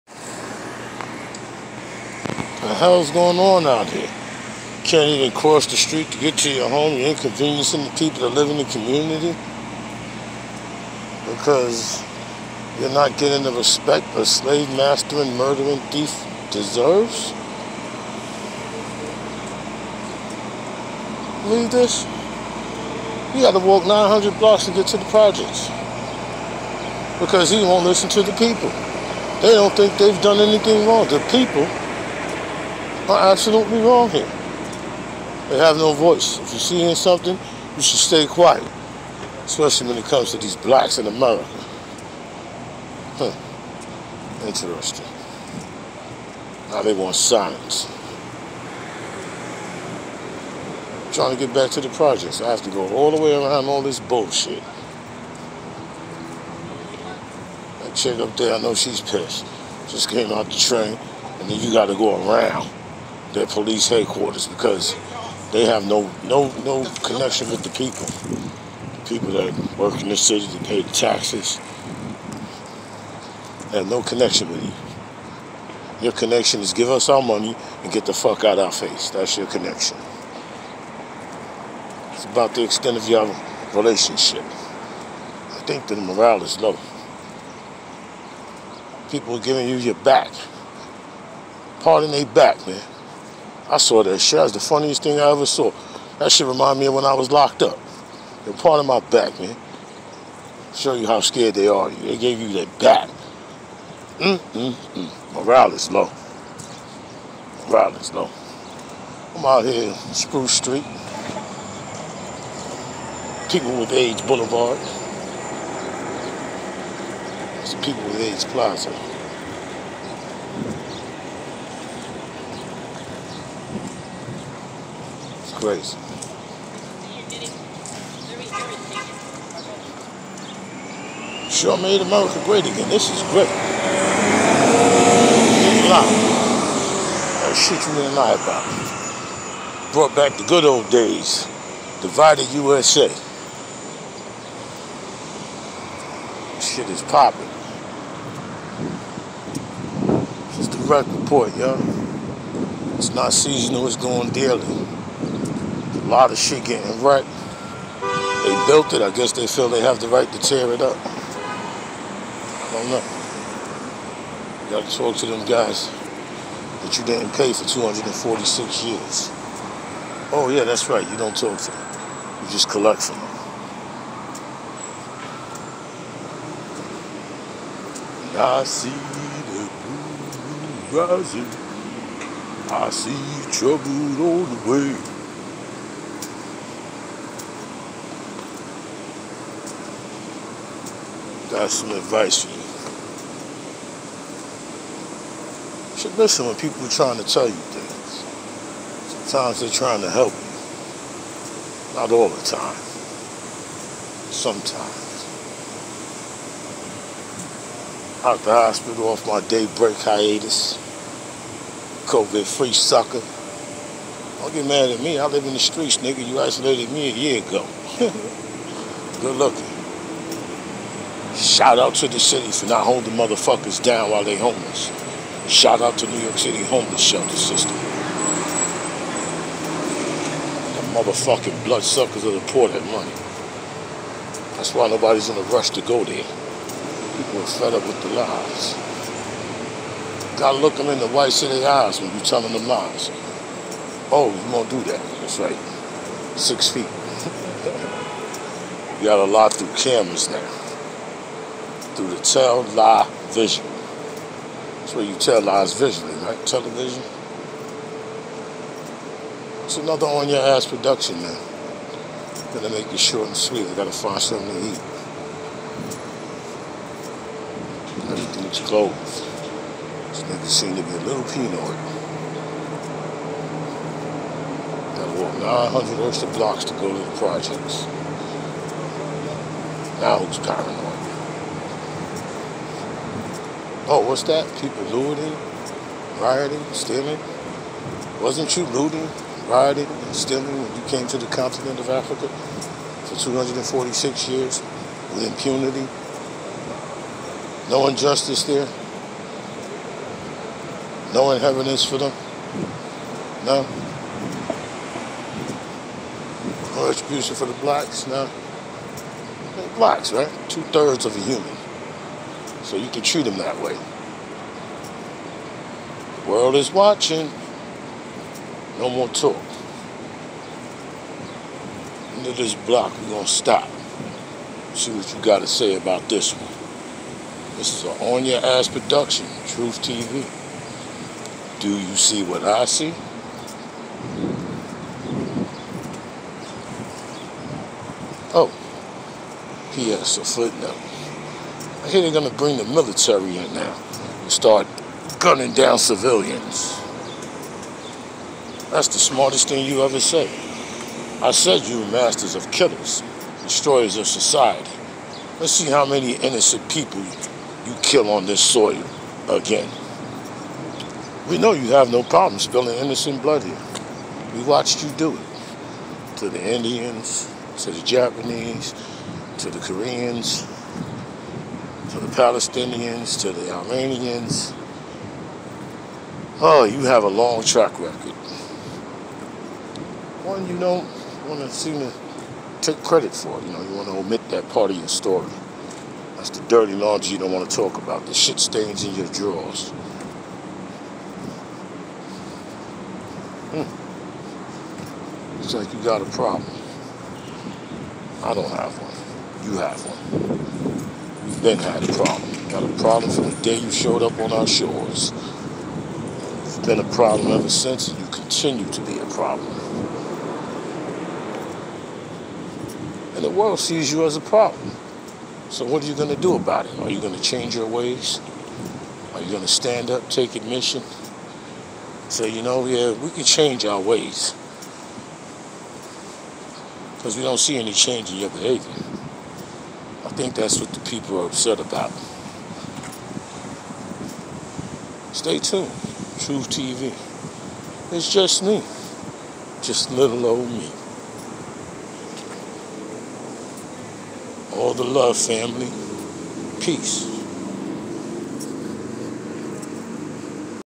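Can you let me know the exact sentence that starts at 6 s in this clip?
You're inconveniencing the people that live in the community because you're not getting the respect a slave master and murdering thief deserves.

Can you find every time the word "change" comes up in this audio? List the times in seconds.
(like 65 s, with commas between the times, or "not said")
417 s, 423 s, 427 s.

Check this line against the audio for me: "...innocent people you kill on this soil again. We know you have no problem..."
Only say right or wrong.
right.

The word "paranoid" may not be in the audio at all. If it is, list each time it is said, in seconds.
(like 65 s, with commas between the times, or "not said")
280 s.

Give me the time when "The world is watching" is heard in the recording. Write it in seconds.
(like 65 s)
316 s.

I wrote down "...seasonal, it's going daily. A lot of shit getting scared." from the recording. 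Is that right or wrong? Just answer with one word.
wrong.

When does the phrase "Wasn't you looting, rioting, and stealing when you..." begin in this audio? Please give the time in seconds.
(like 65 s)
288 s.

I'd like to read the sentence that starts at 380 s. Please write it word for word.
One you don't want to seem to take credit for.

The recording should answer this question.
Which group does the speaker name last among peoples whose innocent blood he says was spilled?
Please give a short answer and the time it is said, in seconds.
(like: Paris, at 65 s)
Armenians, at 373 s.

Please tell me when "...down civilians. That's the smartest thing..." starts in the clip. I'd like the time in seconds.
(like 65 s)
345 s.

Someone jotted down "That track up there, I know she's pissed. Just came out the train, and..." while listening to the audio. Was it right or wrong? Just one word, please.
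wrong.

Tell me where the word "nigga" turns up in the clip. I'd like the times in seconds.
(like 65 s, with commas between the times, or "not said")
215 s, 270 s.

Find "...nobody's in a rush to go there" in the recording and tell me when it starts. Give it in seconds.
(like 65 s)
234 s.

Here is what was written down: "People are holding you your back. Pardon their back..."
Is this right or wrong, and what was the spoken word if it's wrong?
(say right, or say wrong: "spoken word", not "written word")
wrong: "giving", not "holding".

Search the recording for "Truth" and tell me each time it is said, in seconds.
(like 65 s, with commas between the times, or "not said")
329 s, 436 s.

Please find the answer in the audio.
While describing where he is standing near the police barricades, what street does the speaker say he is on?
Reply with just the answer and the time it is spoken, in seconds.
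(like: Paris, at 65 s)
Spruce Street, at 110 s.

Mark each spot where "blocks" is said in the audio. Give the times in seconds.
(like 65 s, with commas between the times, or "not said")
24 s, 276 s, 322 s.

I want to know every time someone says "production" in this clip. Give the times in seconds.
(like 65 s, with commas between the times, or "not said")
260 s, 328 s.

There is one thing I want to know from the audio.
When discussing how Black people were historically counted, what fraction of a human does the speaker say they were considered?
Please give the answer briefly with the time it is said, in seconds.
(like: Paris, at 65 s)
Two thirds, at 310 s.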